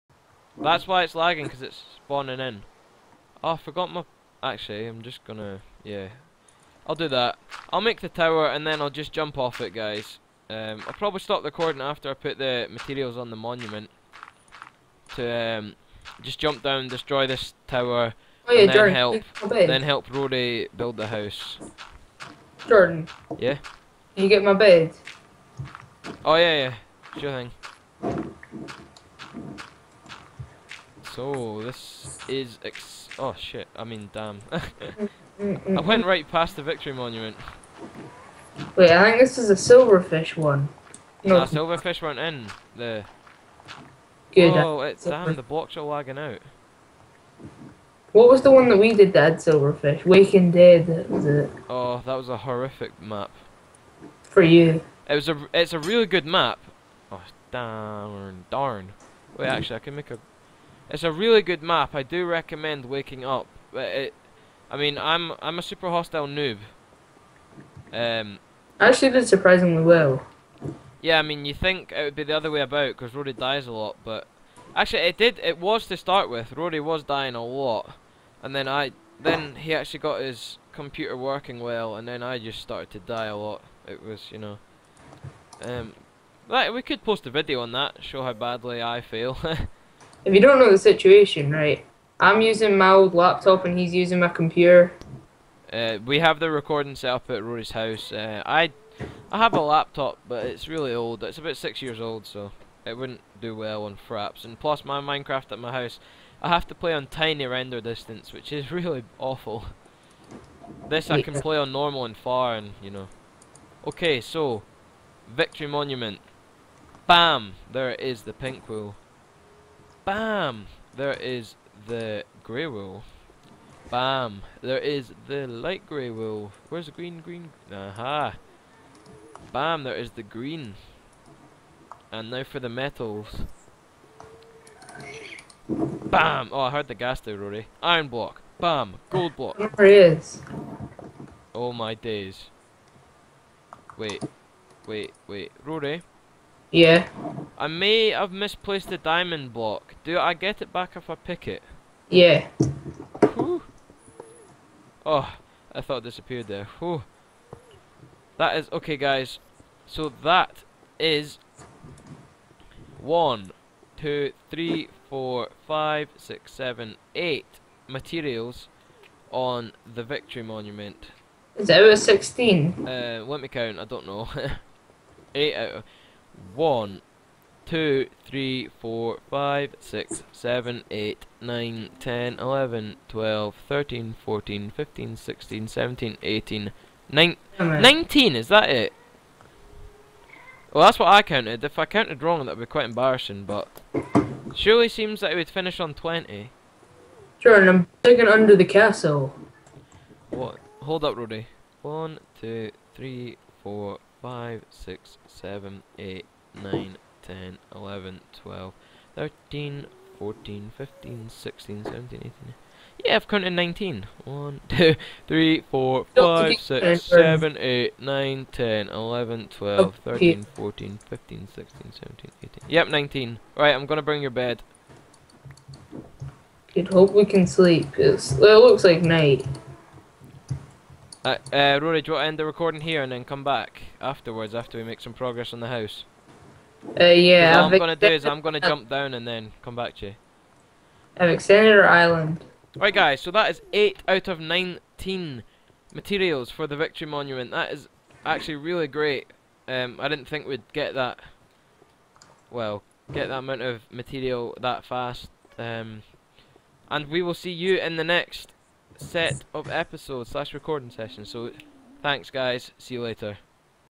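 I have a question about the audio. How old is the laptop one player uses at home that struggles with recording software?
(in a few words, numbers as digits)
6 years old.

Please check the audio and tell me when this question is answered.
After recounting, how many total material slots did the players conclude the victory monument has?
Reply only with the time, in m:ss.
4:04.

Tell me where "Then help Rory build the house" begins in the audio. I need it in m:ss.
0:19.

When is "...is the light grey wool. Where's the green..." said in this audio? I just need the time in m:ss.
2:04.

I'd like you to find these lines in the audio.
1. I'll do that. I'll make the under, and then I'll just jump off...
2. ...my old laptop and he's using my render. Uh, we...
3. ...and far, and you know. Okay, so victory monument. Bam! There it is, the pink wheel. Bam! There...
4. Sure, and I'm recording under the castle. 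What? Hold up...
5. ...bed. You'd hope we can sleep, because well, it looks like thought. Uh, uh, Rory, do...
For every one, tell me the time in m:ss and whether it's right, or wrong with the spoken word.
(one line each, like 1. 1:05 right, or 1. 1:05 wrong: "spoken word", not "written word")
1. 0:06 wrong: "tower", not "under"
2. 1:32 wrong: "computer", not "render"
3. 1:52 right
4. 3:17 wrong: "digging", not "recording"
5. 3:44 wrong: "night", not "thought".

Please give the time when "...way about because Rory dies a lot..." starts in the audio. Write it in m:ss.
1:12.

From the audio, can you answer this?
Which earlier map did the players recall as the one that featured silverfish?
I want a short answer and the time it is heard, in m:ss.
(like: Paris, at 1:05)
Waking Dead, at 0:50.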